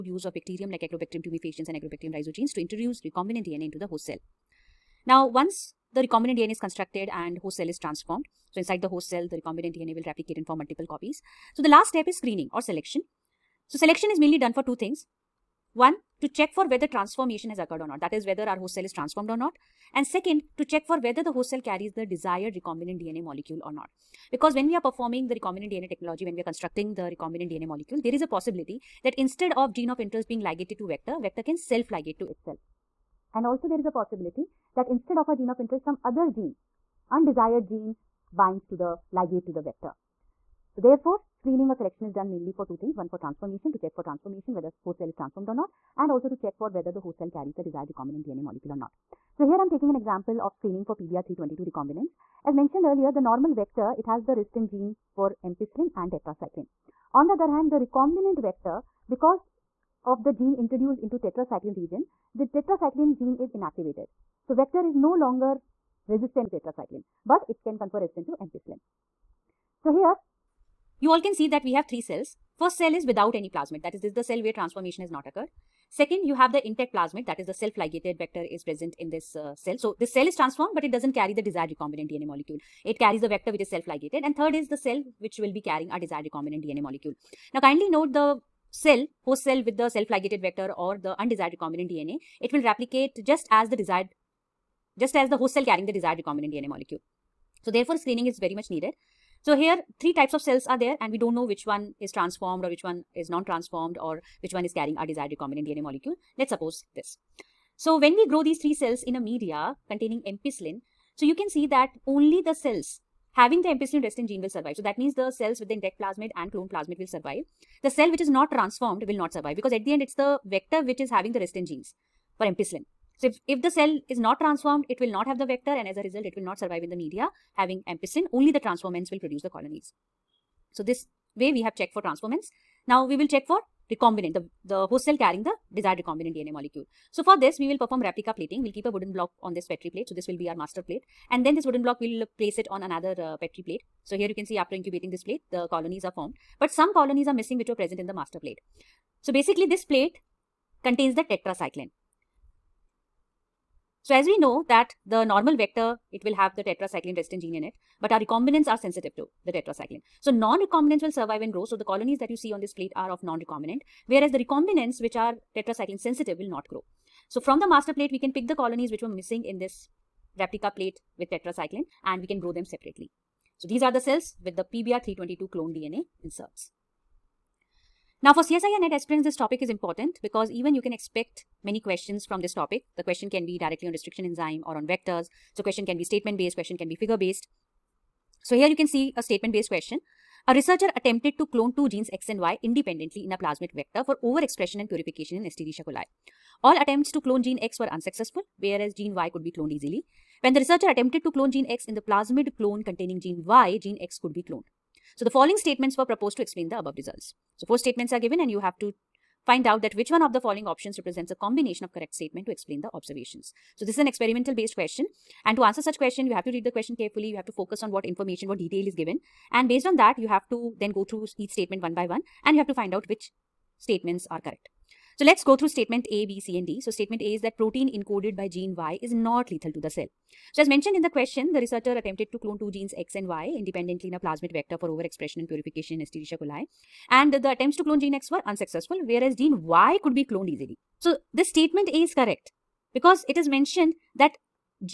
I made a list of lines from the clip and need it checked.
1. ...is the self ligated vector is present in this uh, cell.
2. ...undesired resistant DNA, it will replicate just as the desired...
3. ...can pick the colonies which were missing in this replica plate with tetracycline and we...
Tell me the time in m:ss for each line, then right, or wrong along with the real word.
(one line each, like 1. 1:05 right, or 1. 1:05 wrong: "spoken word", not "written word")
1. 1:17 right
2. 1:31 wrong: "recombinant", not "resistant"
3. 2:48 right.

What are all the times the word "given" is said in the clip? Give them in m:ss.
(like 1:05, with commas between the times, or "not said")
3:28, 3:38.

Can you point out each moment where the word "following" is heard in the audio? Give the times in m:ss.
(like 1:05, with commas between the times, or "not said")
3:25, 3:30.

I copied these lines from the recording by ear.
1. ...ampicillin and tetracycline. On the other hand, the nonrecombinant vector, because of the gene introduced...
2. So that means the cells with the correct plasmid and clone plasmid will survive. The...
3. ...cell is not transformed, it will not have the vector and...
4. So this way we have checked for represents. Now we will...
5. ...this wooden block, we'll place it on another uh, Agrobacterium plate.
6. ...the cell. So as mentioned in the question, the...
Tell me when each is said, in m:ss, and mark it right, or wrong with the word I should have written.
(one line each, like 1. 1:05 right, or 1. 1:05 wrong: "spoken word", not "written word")
1. 0:55 wrong: "recombinant", not "nonrecombinant"
2. 1:54 wrong: "intact", not "correct"
3. 2:03 right
4. 2:10 wrong: "transformants", not "represents"
5. 2:21 wrong: "Petri", not "Agrobacterium"
6. 3:49 right.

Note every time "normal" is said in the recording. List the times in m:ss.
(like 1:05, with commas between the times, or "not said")
0:53, 2:35.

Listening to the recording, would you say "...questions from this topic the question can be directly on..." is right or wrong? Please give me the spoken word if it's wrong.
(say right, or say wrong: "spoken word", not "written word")
right.